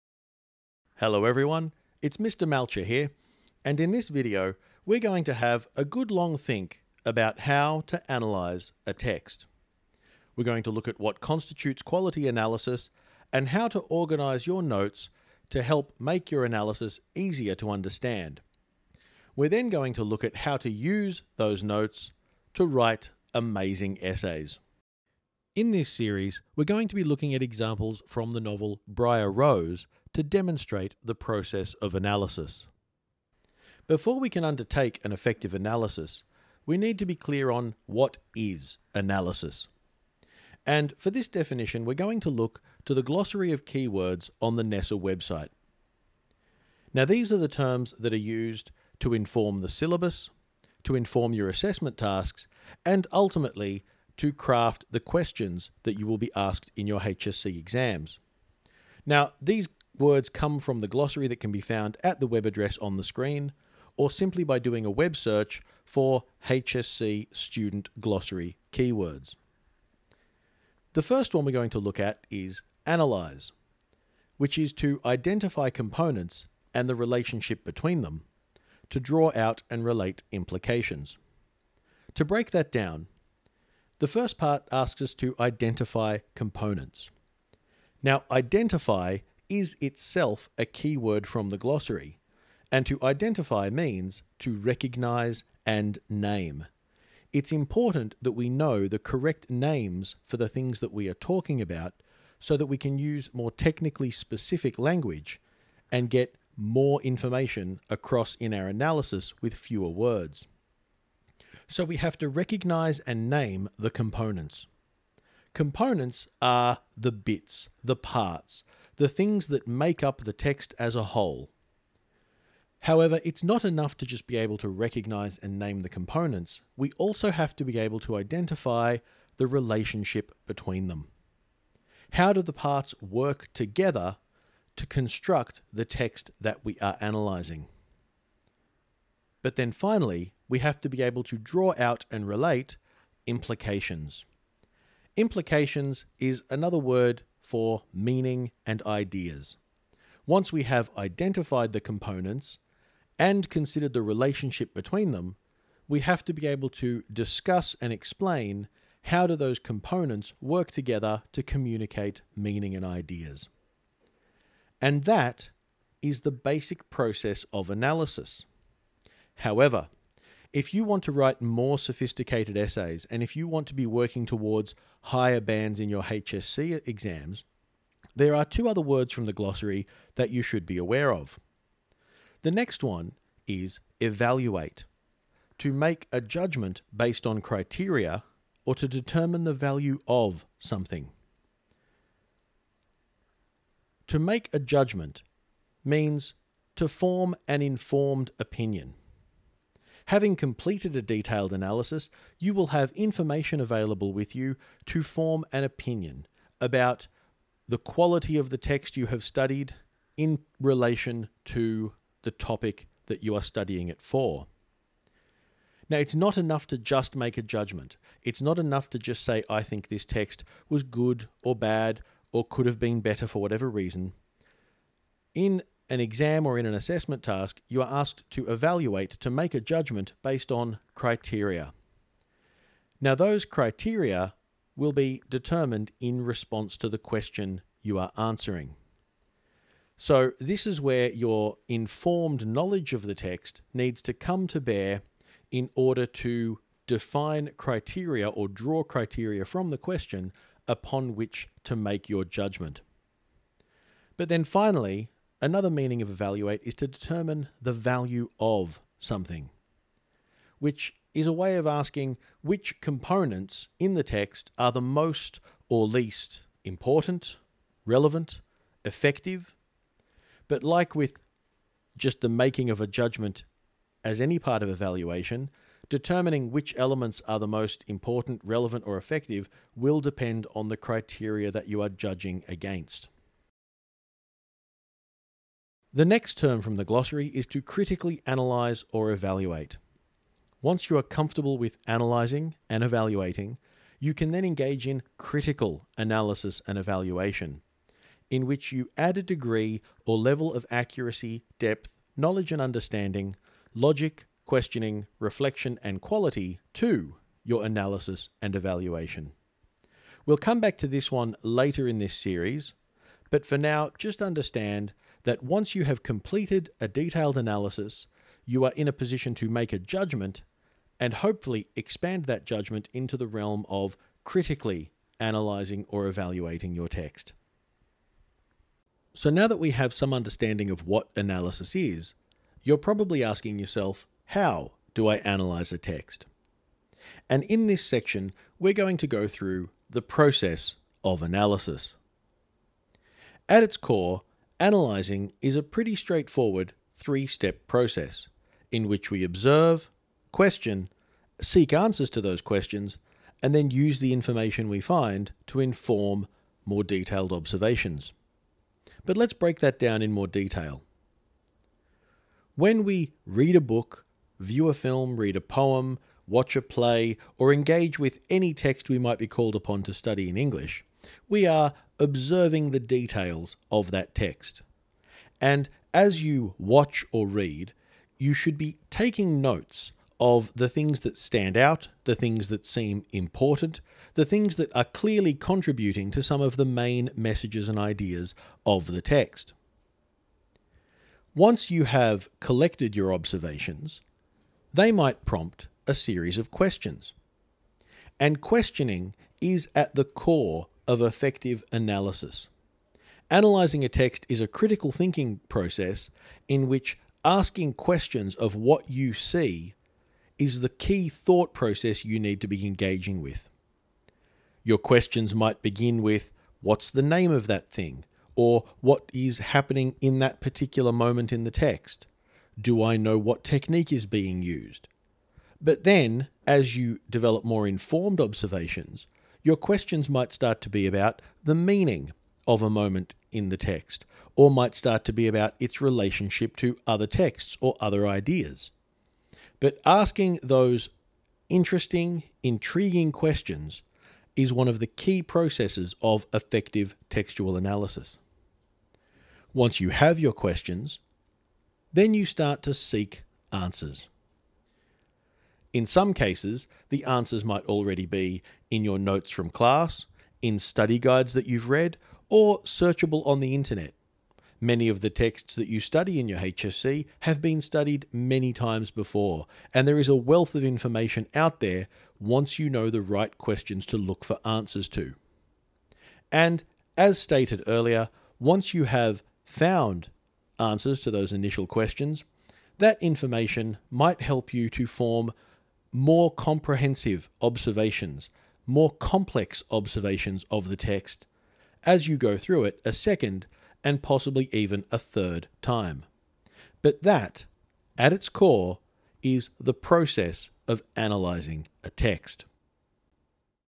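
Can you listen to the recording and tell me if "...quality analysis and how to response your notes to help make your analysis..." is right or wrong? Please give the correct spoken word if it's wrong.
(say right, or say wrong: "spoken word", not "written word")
wrong: "organise", not "response".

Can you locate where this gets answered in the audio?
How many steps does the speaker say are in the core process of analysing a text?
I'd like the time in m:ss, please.
5:46.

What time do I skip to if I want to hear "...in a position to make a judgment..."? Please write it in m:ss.
5:18.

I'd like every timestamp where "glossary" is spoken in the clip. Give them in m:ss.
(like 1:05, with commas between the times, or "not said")
0:43, 1:00, 1:07, 1:31, 2:59, 4:46.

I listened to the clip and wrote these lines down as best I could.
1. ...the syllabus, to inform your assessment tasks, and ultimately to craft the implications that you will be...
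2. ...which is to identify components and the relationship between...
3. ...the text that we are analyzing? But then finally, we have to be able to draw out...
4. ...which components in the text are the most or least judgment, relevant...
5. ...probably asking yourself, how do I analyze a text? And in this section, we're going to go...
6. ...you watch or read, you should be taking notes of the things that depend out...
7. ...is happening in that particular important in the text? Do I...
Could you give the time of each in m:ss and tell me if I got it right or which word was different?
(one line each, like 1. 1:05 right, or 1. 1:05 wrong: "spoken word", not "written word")
1. 0:49 wrong: "questions", not "implications"
2. 1:14 right
3. 2:15 right
4. 4:22 wrong: "important", not "judgment"
5. 5:32 right
6. 6:16 wrong: "stand", not "depend"
7. 6:59 wrong: "moment", not "important".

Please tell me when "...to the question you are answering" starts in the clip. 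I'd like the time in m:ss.
3:56.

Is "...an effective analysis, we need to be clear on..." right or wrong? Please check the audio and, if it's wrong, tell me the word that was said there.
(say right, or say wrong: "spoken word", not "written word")
right.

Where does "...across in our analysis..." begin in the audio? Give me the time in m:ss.
1:47.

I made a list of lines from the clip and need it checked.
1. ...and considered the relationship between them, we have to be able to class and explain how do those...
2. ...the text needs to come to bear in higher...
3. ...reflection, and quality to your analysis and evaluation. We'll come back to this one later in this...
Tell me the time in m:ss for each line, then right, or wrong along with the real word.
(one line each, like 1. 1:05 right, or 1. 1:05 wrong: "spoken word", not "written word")
1. 2:33 wrong: "discuss", not "class"
2. 4:03 wrong: "order", not "higher"
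3. 5:05 right.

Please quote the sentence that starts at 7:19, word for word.
But asking those interesting, intriguing questions is one of the key processes of effective textual analysis.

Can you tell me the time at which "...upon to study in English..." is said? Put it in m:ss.
6:09.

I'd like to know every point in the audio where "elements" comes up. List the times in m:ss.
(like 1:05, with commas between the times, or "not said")
4:36.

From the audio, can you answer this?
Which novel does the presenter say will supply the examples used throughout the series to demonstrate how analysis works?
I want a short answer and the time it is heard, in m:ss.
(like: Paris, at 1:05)
Briar Rose, at 0:28.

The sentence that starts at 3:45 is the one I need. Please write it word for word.
In an exam or in an assessment task, you are asked to evaluate to make a judgment based on criteria.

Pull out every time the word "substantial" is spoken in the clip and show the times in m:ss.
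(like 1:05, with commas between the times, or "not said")
not said.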